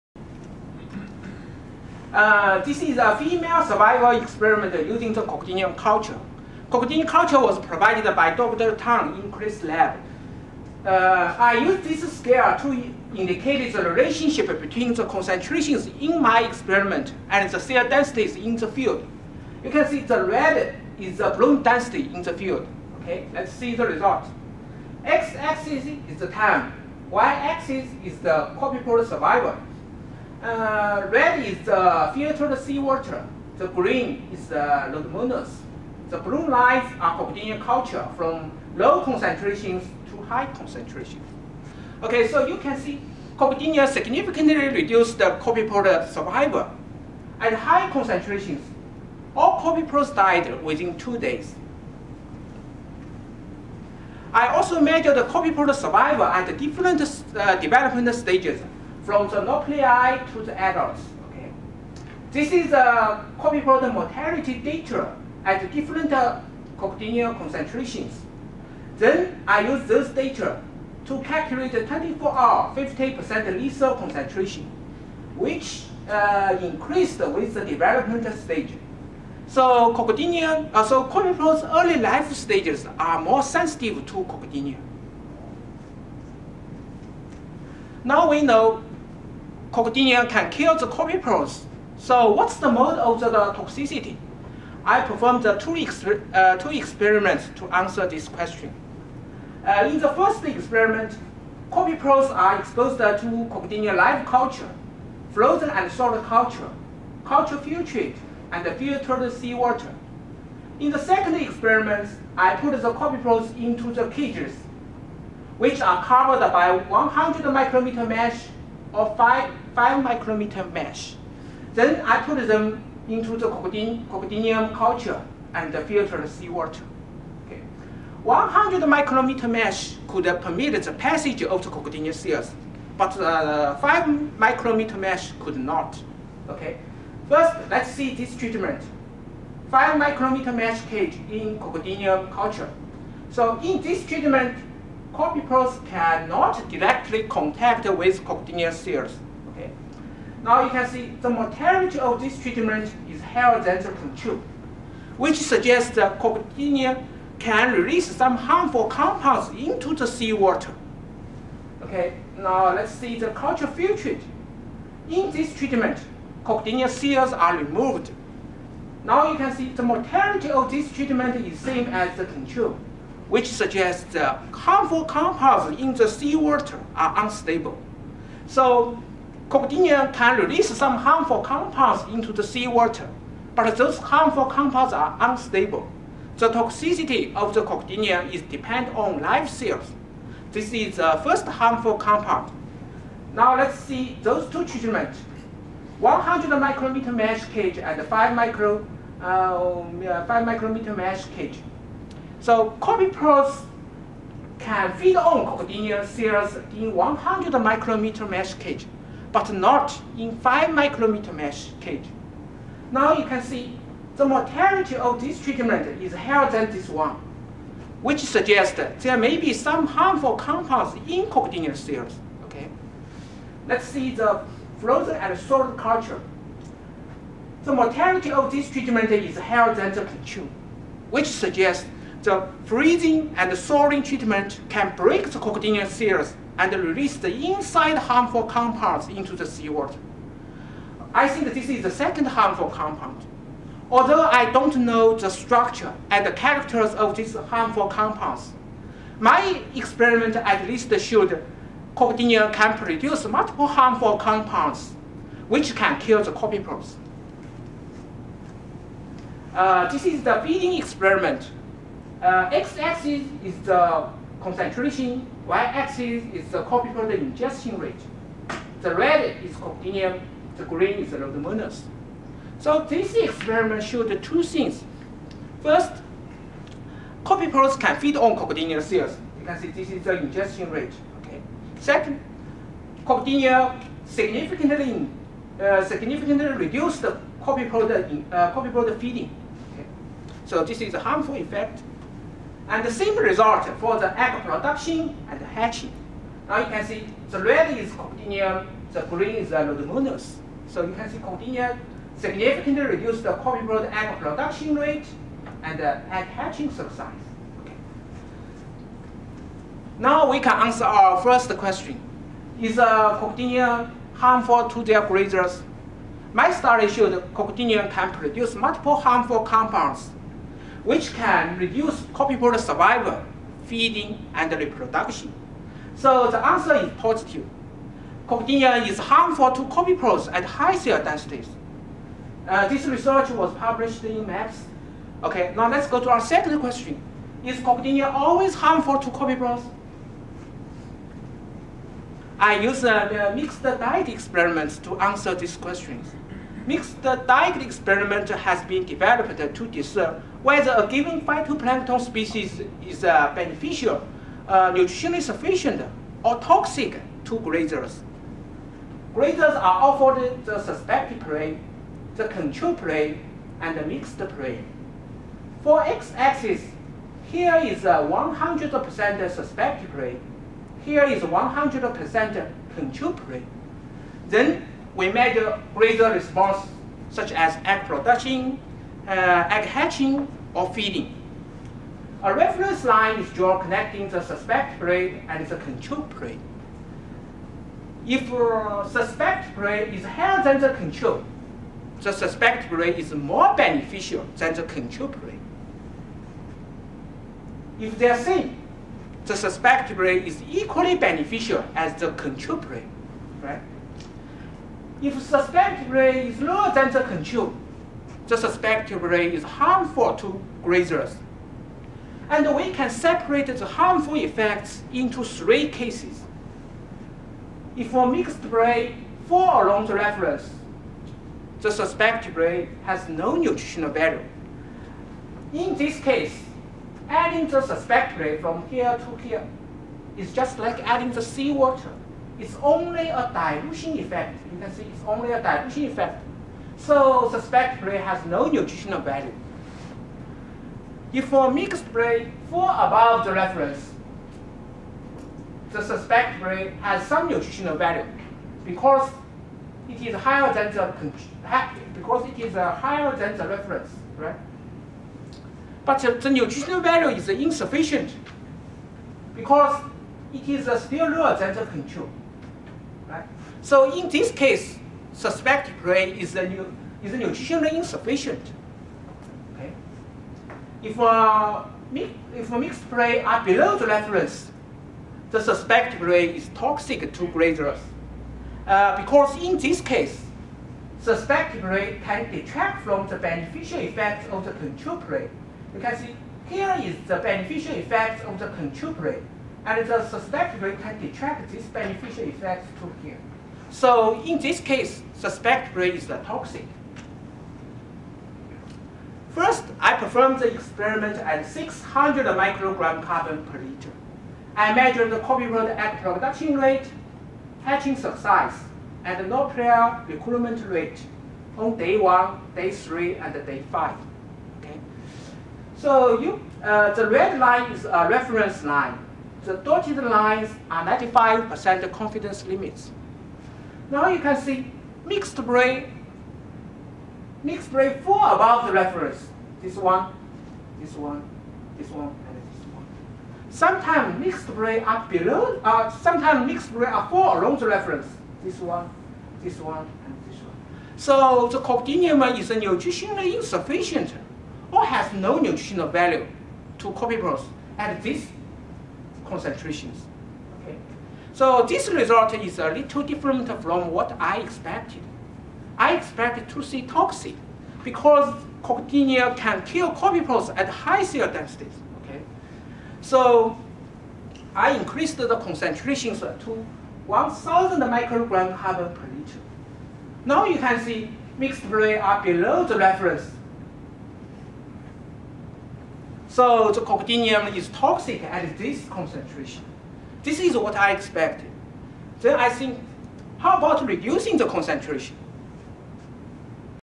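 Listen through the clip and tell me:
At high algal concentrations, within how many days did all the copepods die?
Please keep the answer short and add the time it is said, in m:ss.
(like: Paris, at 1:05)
2 days, at 0:50.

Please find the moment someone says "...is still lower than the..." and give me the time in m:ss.
7:40.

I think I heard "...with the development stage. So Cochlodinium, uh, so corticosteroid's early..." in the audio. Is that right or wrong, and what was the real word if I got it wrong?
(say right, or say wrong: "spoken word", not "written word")
right.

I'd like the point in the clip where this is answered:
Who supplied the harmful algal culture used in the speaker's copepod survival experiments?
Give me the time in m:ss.
0:08.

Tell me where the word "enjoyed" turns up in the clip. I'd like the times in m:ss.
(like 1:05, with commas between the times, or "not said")
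not said.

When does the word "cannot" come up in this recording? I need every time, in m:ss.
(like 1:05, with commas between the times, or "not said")
2:25.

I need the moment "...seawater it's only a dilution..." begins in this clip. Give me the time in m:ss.
7:11.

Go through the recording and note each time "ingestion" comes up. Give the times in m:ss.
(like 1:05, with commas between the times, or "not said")
4:27, 4:40.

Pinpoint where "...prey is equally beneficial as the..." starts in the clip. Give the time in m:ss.
6:39.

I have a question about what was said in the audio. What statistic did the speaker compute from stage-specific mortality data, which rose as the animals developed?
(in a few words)
24-hour 50% lethal concentration.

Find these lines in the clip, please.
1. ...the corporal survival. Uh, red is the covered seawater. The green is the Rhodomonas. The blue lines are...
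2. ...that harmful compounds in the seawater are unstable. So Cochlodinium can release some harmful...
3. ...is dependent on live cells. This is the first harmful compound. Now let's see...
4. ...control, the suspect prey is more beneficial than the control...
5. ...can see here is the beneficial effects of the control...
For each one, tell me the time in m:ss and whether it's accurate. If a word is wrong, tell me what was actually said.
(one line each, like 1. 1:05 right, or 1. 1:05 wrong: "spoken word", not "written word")
1. 0:28 wrong: "filtered", not "covered"
2. 2:54 right
3. 3:08 right
4. 6:30 right
5. 8:05 right.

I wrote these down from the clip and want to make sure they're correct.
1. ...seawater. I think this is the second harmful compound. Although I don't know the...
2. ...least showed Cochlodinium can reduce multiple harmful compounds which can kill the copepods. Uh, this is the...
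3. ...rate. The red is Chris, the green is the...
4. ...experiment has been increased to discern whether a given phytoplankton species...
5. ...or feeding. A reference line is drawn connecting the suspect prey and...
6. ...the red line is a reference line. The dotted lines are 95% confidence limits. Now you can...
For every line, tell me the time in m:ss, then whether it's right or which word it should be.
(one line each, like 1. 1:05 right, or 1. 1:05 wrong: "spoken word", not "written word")
1. 3:59 right
2. 4:10 wrong: "produce", not "reduce"
3. 4:27 wrong: "Cochlodinium", not "Chris"
4. 5:47 wrong: "developed", not "increased"
5. 6:20 right
6. 8:36 right.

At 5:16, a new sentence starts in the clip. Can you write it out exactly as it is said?
My study showed Cochlodinium can produce multiple harmful compounds which can reduce copepods' survival, feeding, and reproduction.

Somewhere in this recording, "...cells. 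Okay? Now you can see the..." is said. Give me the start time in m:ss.
2:28.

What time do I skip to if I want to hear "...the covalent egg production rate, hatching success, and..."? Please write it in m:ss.
8:25.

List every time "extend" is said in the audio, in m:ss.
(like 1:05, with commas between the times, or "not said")
not said.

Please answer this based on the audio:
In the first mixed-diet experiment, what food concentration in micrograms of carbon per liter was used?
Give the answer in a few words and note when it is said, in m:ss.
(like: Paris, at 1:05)
600, at 8:21.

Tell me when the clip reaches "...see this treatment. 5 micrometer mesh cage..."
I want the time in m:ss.
2:17.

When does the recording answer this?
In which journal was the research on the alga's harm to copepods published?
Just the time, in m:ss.
5:34.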